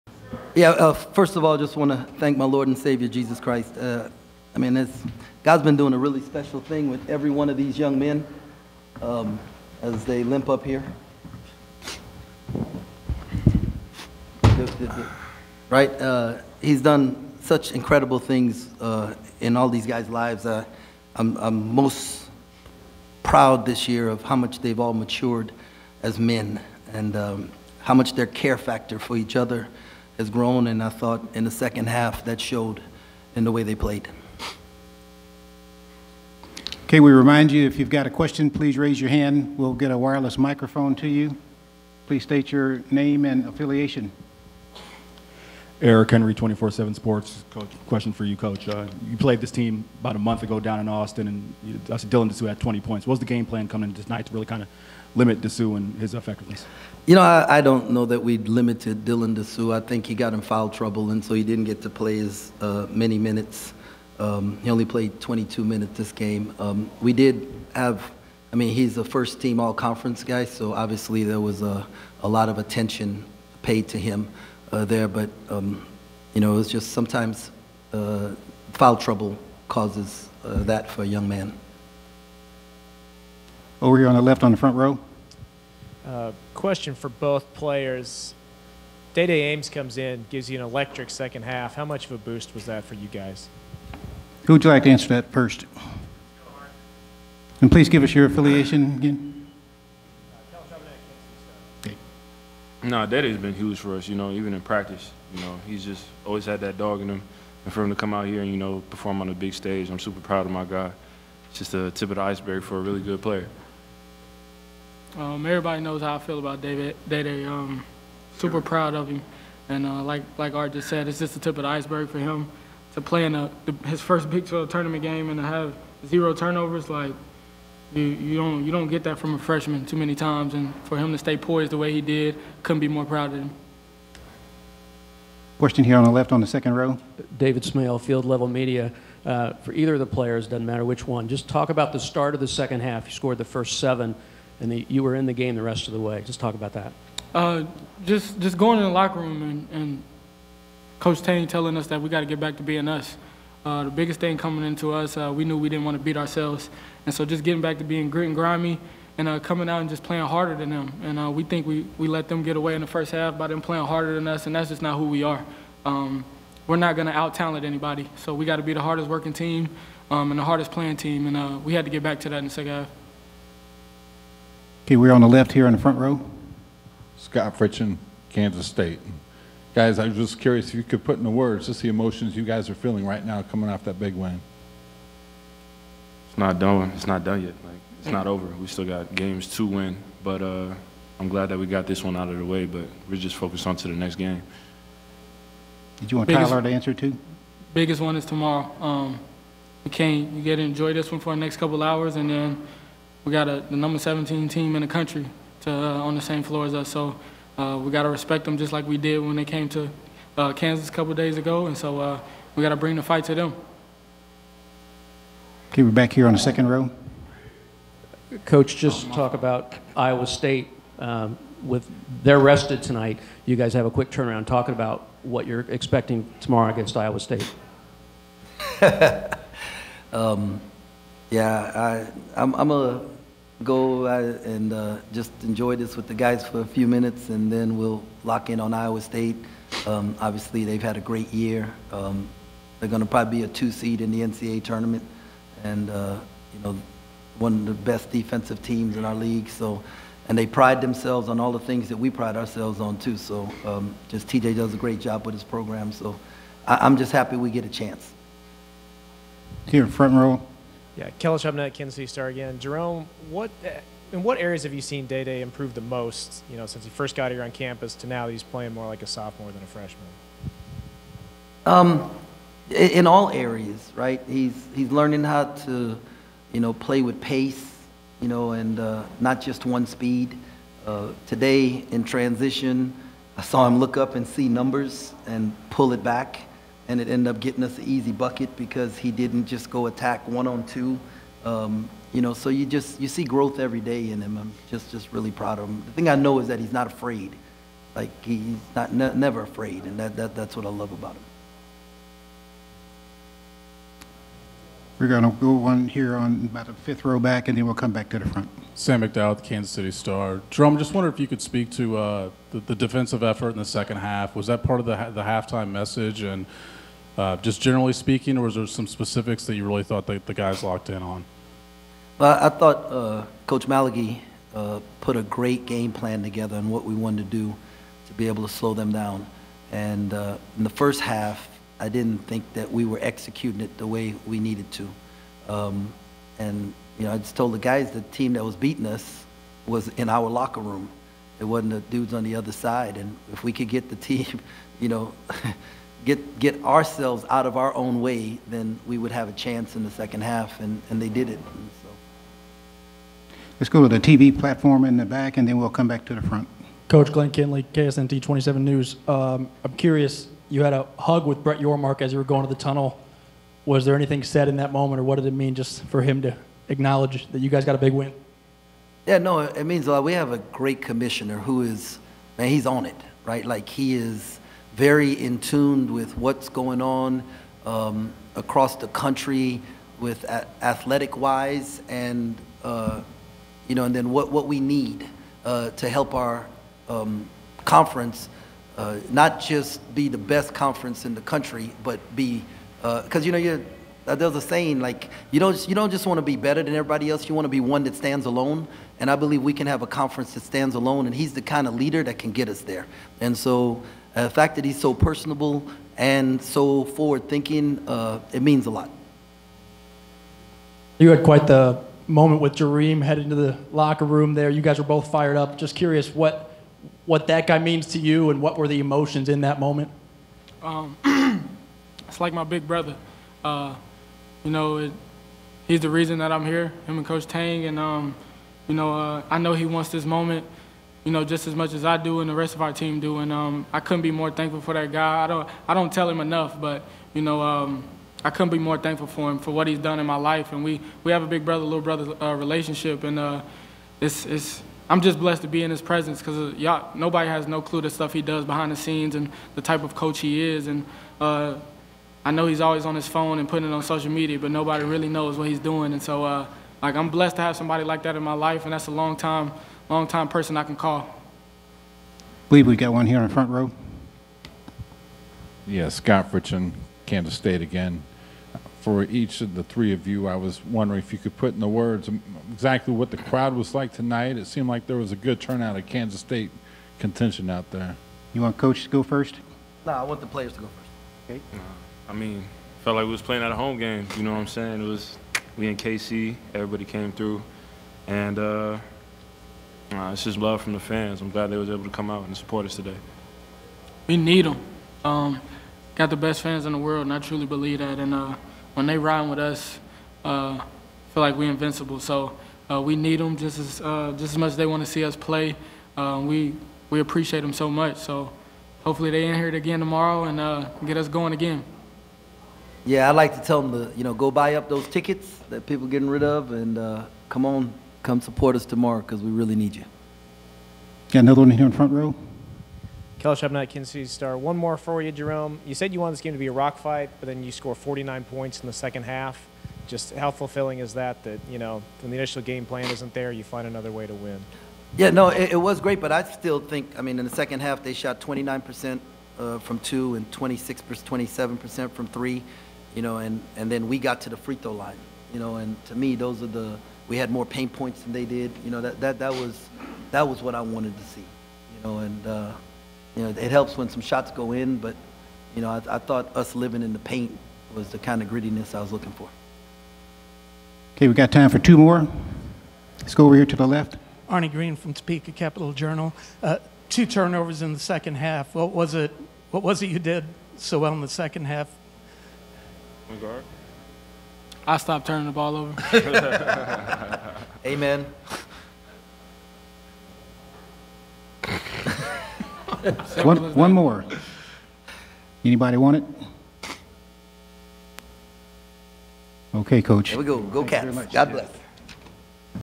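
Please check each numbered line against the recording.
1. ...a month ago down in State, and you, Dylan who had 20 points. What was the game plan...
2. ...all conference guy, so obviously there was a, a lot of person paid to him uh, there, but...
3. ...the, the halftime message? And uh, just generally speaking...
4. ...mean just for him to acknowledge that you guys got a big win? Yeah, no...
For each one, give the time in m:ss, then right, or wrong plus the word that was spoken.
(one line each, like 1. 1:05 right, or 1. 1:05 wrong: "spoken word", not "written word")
1. 0:50 wrong: "Austin", not "State"
2. 1:09 wrong: "attention", not "person"
3. 5:14 right
4. 6:05 right.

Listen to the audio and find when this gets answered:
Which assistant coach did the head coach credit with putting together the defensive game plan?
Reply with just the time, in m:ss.
5:23.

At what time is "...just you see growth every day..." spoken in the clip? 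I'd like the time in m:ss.
4:52.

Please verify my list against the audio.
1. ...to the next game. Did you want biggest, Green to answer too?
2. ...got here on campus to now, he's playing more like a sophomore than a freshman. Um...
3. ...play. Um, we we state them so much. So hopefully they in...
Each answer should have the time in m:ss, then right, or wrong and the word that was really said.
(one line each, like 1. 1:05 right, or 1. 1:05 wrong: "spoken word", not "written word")
1. 3:13 wrong: "Tylor", not "Green"
2. 4:27 right
3. 8:25 wrong: "appreciate", not "state".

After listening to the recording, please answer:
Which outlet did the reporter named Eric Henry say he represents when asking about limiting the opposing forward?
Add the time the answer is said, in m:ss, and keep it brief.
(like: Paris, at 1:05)
24/7 Sports, at 0:46.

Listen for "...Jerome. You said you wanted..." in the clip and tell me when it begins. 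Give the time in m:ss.
8:45.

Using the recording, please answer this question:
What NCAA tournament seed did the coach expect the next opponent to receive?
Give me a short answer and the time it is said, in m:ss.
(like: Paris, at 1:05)
2, at 4:03.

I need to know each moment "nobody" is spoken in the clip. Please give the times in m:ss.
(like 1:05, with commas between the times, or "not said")
7:26, 7:34.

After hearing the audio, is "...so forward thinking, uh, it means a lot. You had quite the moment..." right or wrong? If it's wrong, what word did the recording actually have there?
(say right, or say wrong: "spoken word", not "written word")
right.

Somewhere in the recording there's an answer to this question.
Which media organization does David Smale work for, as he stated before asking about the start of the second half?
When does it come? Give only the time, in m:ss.
2:17.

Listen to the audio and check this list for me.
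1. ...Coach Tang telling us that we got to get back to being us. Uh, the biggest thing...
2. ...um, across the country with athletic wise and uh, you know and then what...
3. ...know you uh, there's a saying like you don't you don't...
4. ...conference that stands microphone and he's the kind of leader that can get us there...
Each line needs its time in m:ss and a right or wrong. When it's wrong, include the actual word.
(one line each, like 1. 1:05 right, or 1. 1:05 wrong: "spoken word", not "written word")
1. 2:30 right
2. 6:17 right
3. 6:33 right
4. 6:39 wrong: "alone", not "microphone".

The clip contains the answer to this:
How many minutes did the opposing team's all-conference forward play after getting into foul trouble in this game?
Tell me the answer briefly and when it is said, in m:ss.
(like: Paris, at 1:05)
22, at 1:05.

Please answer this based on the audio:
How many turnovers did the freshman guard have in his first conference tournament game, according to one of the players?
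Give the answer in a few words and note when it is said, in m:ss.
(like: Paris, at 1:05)
0, at 2:06.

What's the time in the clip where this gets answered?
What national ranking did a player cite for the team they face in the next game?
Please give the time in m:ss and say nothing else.
3:23.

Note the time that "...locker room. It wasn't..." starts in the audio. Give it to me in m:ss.
5:40.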